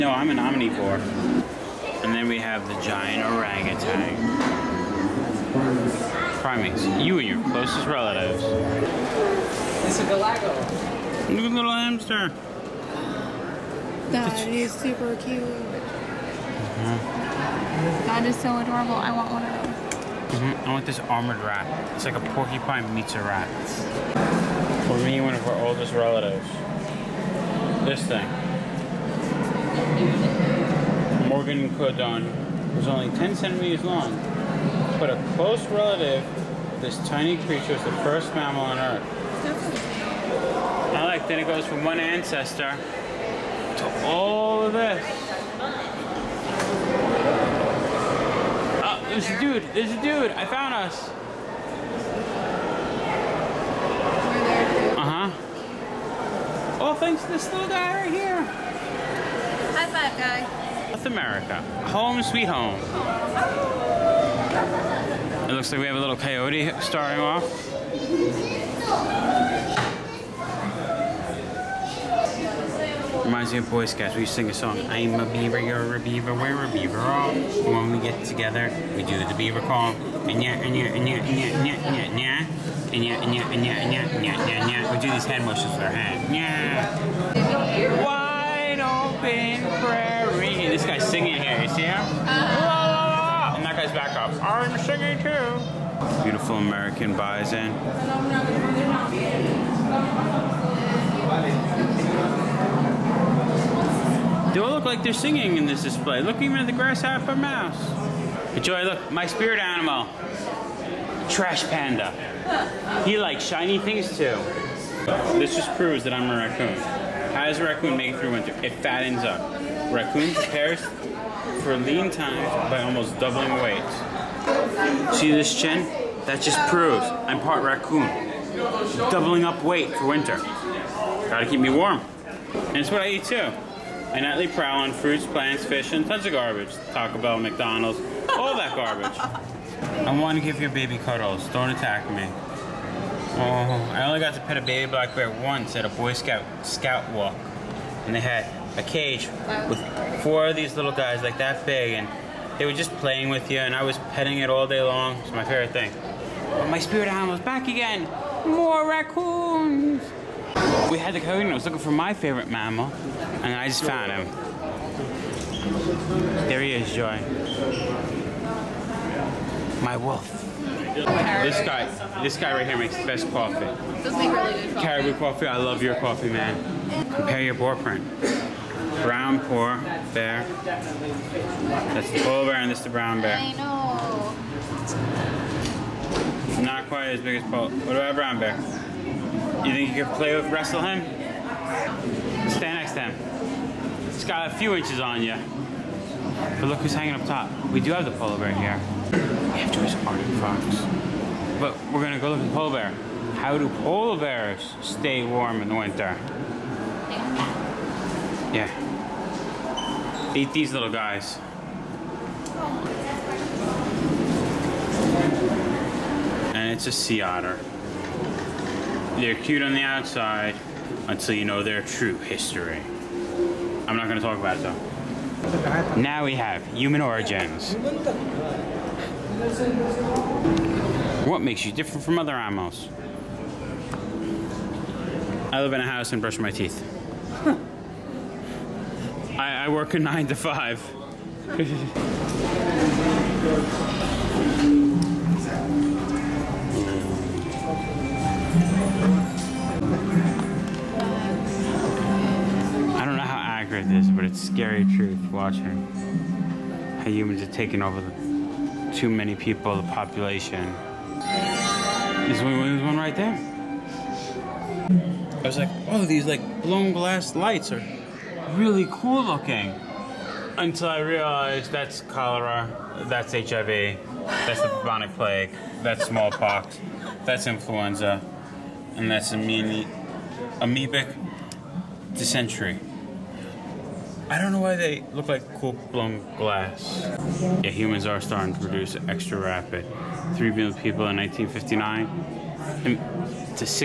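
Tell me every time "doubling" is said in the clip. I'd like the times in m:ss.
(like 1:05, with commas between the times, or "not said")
2:03, 2:09.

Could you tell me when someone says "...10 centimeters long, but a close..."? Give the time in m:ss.
0:33.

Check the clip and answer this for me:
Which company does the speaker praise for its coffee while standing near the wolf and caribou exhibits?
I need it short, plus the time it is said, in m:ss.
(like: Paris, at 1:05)
Caribou Coffee, at 2:54.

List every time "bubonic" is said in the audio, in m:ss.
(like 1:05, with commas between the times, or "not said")
4:34.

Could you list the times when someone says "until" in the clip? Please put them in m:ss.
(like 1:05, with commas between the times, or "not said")
3:41, 4:30.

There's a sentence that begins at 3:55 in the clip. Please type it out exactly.
I live in a house and brush my teeth.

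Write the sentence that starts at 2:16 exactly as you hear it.
Taco Bell, McDonald's, all that garbage.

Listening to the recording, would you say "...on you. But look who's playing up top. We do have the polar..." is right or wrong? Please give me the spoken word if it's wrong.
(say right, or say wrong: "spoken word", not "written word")
wrong: "hanging", not "playing".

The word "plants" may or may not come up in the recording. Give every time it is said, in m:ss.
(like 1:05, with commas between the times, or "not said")
2:15.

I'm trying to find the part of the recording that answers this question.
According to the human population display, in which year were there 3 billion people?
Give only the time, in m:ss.
4:51.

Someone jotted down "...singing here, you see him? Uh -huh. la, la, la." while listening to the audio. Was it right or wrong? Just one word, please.
right.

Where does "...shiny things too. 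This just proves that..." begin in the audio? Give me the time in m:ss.
1:53.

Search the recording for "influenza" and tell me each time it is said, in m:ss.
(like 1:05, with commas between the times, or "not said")
4:37.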